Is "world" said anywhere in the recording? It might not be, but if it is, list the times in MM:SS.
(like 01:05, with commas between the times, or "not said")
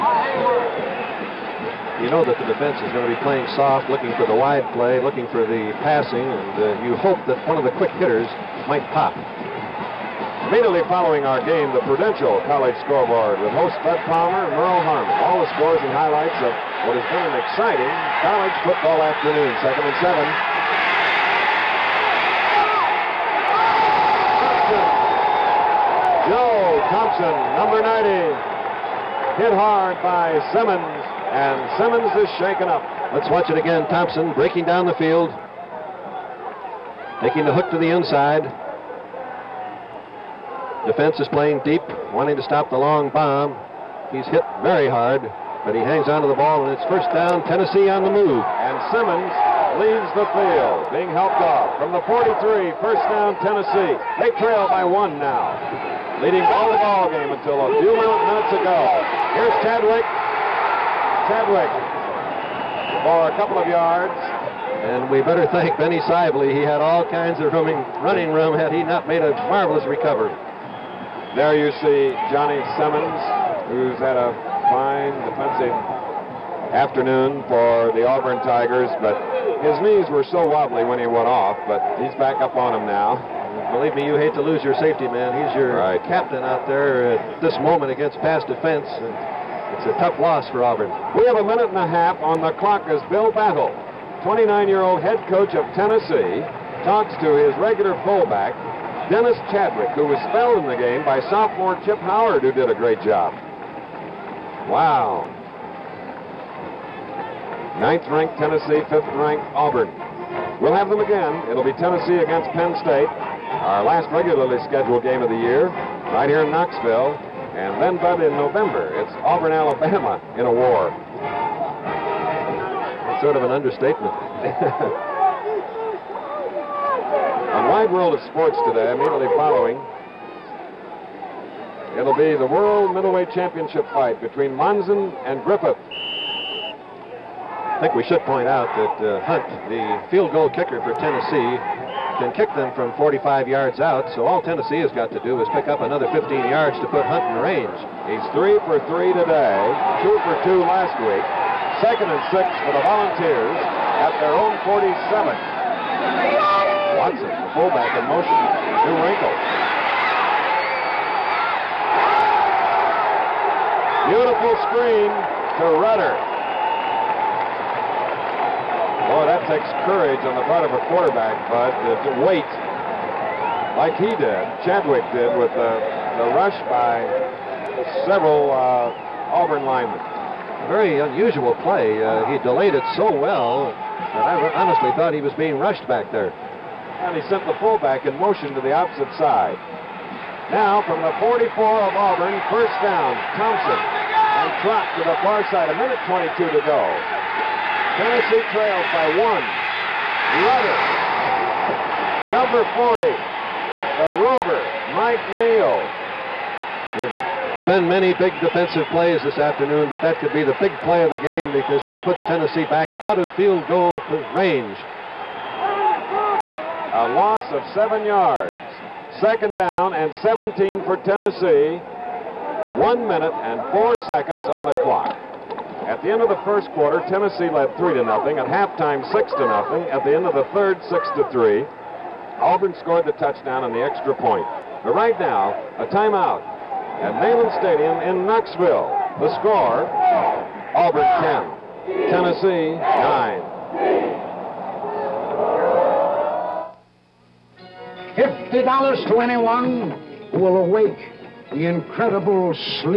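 02:07, 02:12.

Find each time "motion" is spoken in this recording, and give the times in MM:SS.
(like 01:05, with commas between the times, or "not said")
02:38, 03:08.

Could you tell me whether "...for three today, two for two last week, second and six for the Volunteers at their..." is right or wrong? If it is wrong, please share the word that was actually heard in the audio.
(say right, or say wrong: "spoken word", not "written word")
right.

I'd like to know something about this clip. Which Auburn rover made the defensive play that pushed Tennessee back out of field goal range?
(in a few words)
Mike Neal.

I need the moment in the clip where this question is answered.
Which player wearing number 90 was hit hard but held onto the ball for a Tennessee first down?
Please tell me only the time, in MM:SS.
00:26.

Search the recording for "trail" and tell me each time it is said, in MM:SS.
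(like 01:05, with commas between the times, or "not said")
00:54, 03:18.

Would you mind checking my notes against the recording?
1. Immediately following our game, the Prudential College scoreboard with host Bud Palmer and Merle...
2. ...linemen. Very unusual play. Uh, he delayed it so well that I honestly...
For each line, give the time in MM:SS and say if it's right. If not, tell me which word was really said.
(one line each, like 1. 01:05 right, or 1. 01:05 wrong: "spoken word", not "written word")
1. 00:10 right
2. 02:59 right.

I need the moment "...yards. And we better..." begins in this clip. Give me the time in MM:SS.
01:03.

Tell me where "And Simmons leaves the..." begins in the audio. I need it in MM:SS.
00:48.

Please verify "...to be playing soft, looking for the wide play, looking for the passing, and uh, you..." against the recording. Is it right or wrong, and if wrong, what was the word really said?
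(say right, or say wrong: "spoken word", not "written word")
right.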